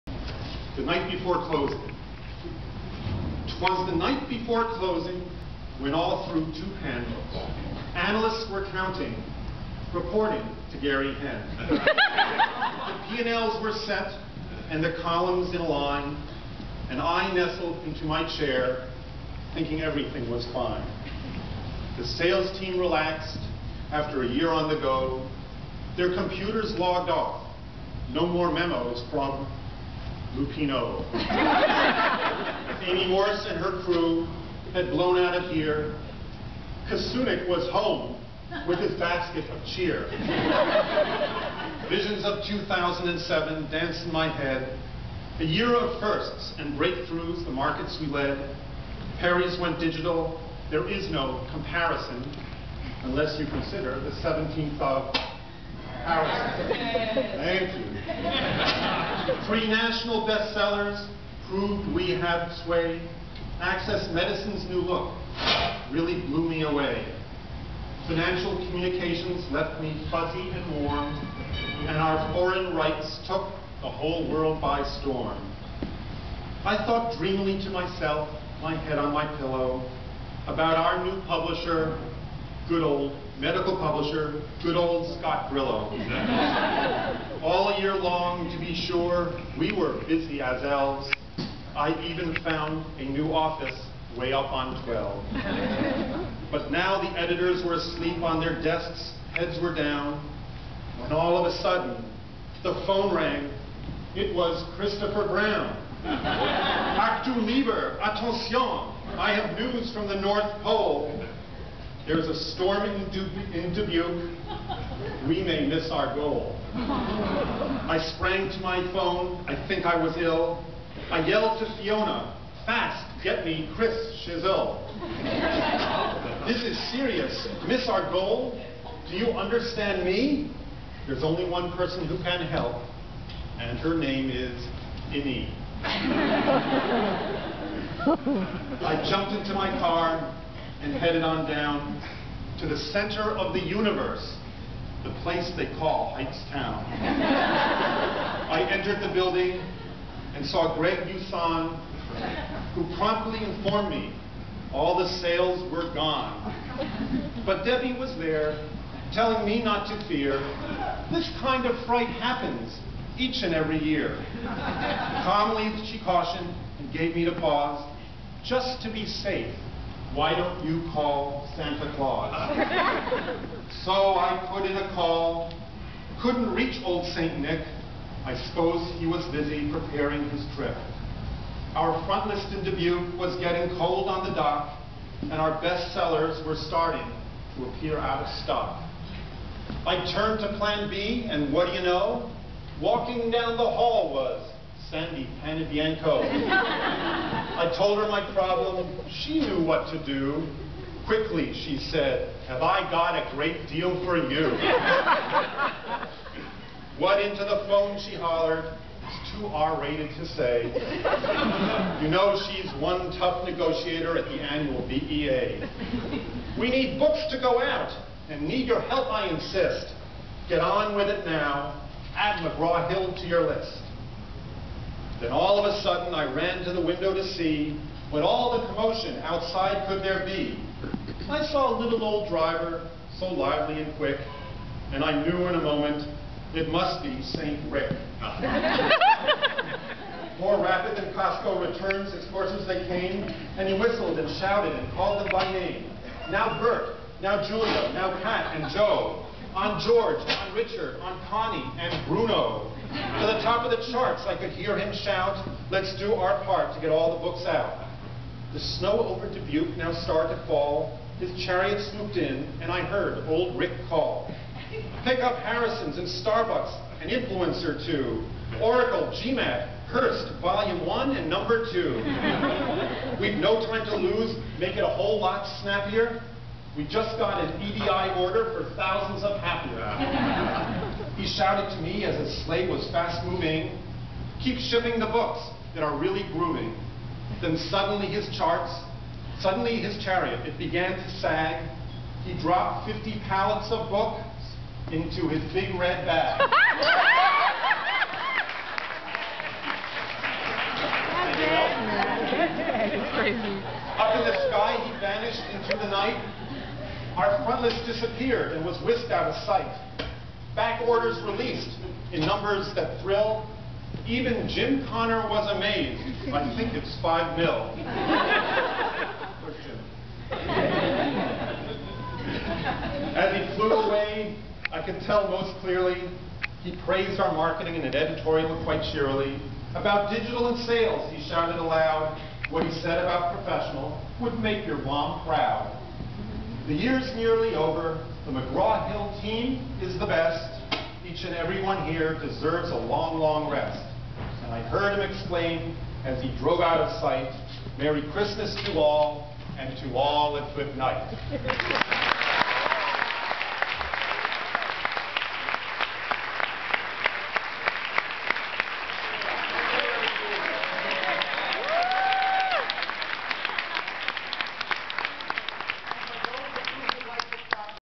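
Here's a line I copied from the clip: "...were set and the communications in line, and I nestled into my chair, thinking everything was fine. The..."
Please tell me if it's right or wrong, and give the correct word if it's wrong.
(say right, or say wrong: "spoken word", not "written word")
wrong: "columns", not "communications".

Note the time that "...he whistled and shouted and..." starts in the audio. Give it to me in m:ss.
4:03.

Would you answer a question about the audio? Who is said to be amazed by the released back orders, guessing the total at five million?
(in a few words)
Jim Connor.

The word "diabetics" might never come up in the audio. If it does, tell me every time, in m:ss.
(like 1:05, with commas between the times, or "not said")
not said.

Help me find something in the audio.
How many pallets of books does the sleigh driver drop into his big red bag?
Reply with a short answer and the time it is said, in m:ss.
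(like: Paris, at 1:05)
50, at 4:52.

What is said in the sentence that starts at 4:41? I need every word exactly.
He shouted to me as his sleigh was fast moving, keep shipping the books that are really grooving.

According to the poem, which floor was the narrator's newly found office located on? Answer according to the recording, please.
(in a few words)
12.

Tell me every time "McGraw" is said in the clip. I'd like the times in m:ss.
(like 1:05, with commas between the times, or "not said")
3:42, 5:38.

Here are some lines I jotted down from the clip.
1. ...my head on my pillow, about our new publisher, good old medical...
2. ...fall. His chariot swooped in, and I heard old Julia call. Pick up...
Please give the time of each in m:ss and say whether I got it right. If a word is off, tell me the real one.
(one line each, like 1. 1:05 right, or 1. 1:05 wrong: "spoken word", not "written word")
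1. 1:18 right
2. 4:20 wrong: "Rick", not "Julia".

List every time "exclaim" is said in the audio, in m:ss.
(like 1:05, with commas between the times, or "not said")
5:45.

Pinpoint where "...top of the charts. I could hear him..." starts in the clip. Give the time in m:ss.
4:13.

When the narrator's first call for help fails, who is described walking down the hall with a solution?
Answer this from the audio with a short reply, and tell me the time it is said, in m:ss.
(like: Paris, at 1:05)
Sandy Panavienko, at 3:14.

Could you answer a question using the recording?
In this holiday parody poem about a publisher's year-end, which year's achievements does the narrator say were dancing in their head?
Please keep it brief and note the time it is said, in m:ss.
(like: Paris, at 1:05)
2007, at 0:42.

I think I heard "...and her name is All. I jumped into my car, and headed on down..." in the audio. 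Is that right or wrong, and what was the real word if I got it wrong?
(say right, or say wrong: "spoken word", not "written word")
wrong: "Innie", not "All".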